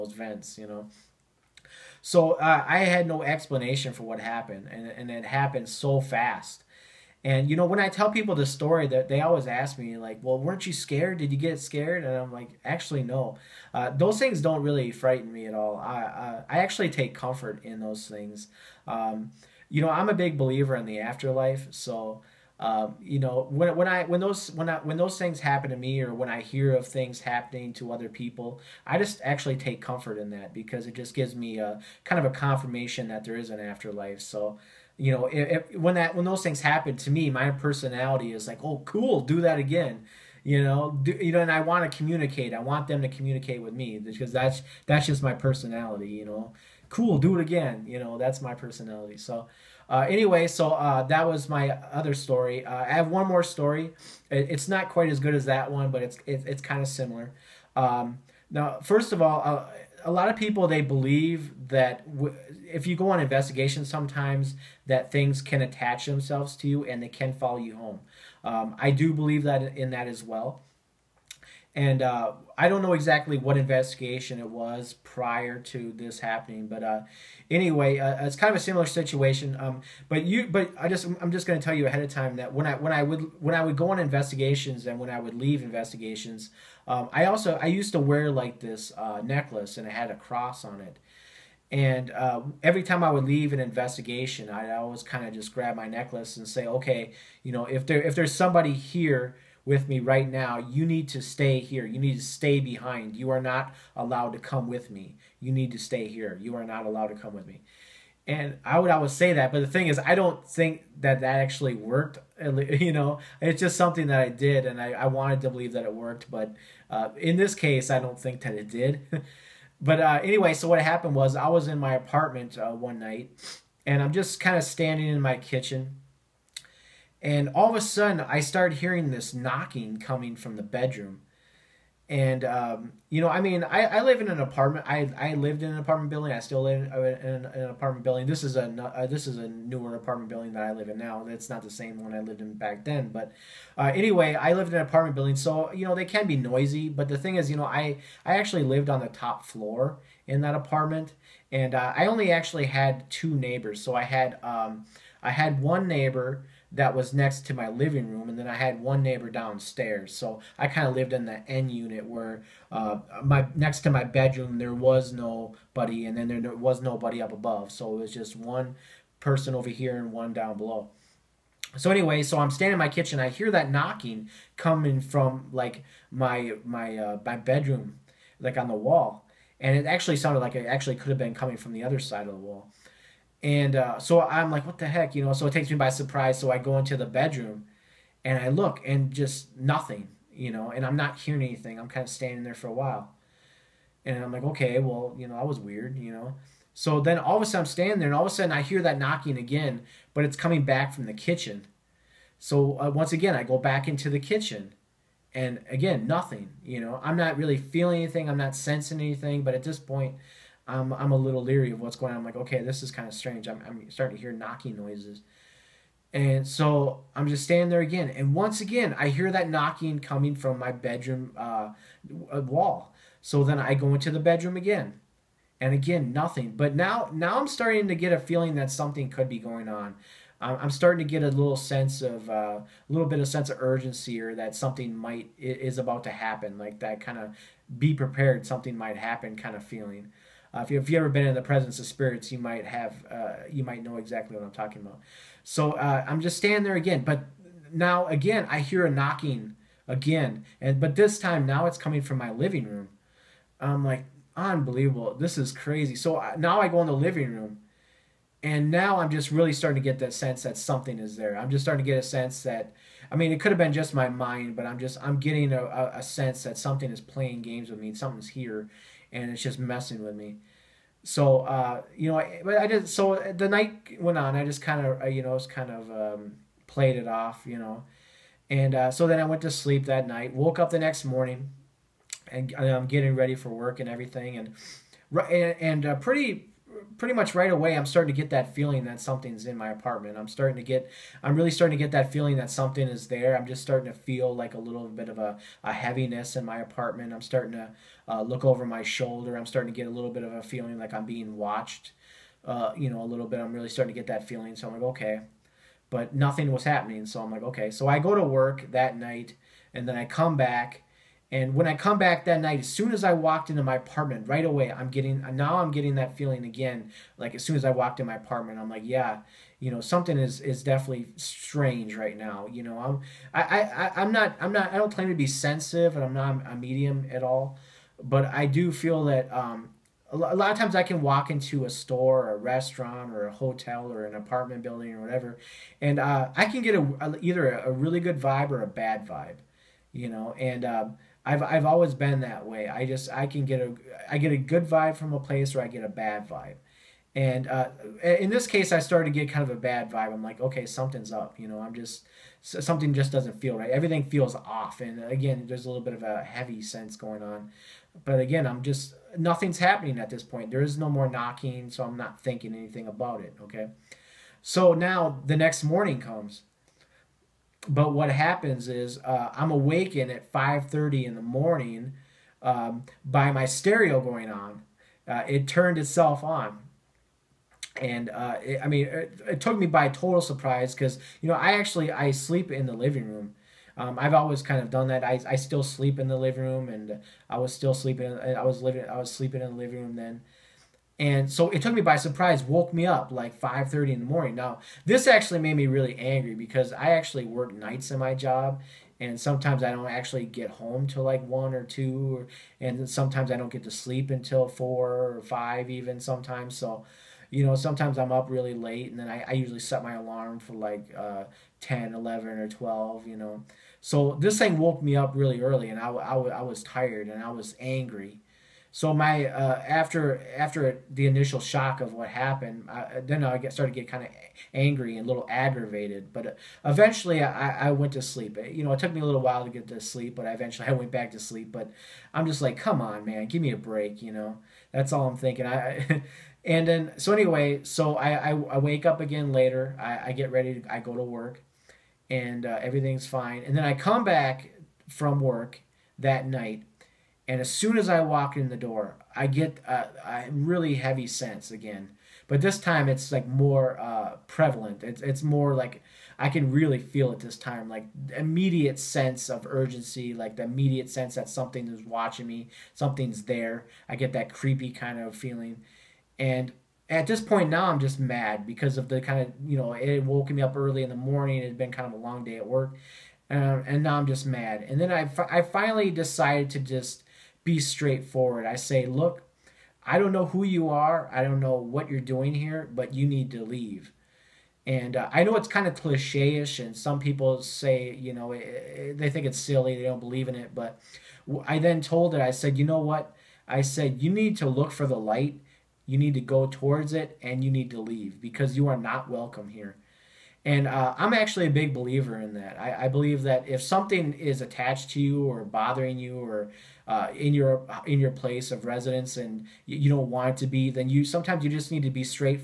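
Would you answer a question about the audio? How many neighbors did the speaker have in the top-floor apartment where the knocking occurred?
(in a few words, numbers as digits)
2.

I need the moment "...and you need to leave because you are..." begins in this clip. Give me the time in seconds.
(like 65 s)
497 s.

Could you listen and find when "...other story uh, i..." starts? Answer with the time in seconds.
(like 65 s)
51 s.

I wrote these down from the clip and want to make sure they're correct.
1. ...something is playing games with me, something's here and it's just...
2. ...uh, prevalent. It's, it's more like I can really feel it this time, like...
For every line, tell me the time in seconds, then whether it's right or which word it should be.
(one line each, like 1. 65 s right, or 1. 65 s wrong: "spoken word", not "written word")
1. 266 s right
2. 453 s right.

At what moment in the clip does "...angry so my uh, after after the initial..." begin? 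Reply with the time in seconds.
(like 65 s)
417 s.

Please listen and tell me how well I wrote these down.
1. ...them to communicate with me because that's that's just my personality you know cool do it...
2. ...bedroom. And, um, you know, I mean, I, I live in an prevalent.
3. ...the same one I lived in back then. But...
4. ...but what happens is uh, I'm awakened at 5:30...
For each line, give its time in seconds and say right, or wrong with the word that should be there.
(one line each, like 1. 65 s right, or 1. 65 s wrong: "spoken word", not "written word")
1. 42 s right
2. 130 s wrong: "apartment", not "prevalent"
3. 141 s right
4. 367 s right.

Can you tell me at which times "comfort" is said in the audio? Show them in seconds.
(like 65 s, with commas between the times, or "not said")
17 s, 29 s.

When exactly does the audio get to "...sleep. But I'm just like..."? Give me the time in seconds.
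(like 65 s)
431 s.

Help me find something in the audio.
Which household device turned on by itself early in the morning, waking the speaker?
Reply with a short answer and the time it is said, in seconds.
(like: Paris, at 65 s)
stereo, at 373 s.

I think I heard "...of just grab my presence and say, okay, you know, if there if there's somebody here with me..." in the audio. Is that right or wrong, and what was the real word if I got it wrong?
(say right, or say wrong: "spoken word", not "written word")
wrong: "necklace", not "presence".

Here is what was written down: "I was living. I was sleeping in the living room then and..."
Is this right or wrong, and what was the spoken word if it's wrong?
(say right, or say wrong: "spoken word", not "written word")
right.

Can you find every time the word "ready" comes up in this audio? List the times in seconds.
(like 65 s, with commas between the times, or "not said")
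283 s, 440 s.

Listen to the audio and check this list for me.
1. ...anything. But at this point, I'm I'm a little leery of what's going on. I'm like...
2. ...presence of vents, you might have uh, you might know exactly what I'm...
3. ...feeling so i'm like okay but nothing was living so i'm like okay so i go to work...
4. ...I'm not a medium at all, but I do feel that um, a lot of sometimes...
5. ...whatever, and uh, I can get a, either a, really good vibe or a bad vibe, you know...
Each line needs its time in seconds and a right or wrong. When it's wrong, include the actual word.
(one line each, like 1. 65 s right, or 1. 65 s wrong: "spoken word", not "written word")
1. 208 s right
2. 241 s wrong: "spirits", not "vents"
3. 304 s wrong: "happening", not "living"
4. 326 s wrong: "times", not "sometimes"
5. 334 s right.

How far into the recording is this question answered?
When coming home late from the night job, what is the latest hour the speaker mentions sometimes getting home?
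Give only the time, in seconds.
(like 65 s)
401 s.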